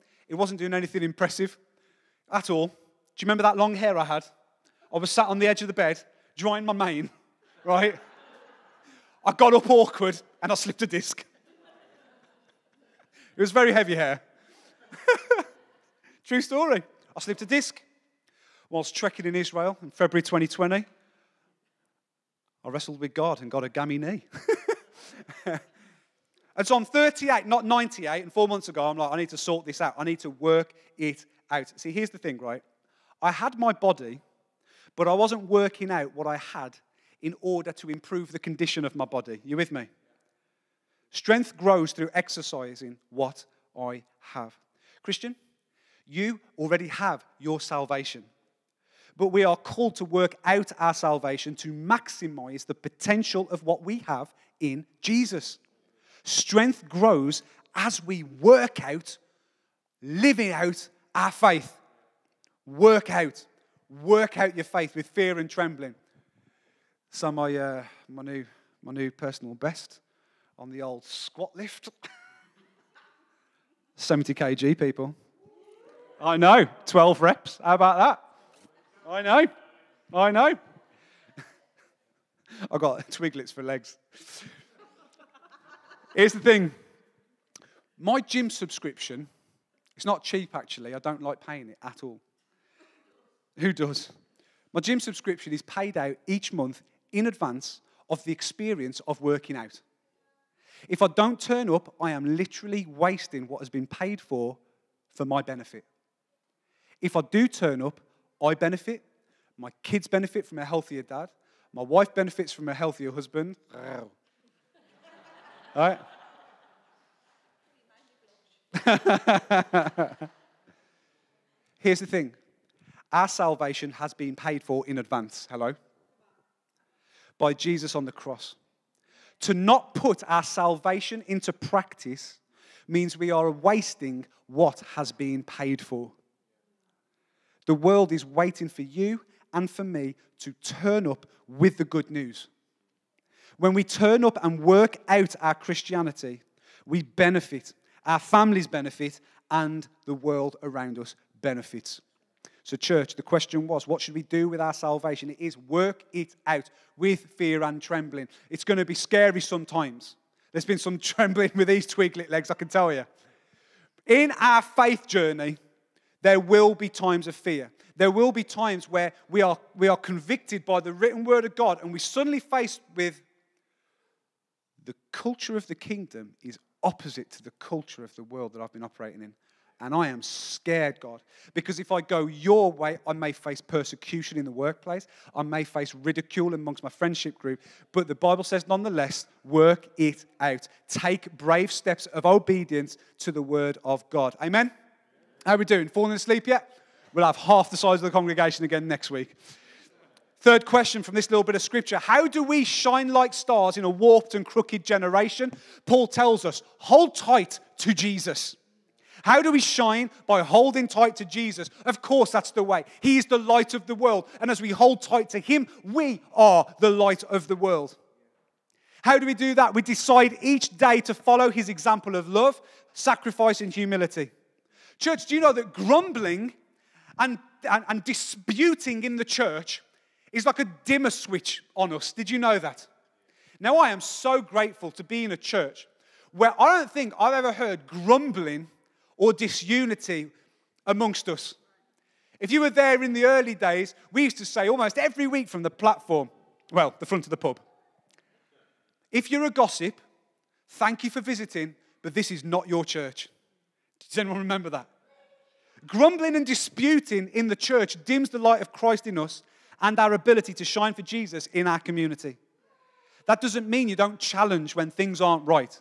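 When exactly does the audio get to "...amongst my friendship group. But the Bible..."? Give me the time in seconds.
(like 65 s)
186 s.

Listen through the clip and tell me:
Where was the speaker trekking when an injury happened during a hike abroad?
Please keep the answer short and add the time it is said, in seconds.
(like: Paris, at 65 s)
Israel, at 19 s.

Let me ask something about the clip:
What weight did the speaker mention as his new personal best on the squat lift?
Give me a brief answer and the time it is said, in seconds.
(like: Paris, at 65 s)
70 kg, at 73 s.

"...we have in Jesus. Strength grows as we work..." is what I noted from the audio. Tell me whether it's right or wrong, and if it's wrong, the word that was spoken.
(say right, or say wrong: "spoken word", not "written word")
right.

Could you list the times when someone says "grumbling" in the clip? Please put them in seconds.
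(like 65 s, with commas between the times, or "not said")
225 s, 237 s, 255 s.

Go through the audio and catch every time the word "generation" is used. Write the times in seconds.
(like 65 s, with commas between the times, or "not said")
204 s.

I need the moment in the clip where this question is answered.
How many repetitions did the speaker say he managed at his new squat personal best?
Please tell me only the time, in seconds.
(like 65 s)
76 s.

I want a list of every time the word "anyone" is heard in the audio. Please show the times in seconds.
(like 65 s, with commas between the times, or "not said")
254 s.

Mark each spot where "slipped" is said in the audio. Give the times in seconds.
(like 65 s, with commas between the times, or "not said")
10 s, 17 s.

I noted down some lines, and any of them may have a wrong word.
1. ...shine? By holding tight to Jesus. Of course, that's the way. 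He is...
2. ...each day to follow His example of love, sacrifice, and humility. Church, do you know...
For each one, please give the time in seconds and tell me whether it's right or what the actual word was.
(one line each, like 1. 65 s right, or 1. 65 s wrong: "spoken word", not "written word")
1. 209 s right
2. 220 s right.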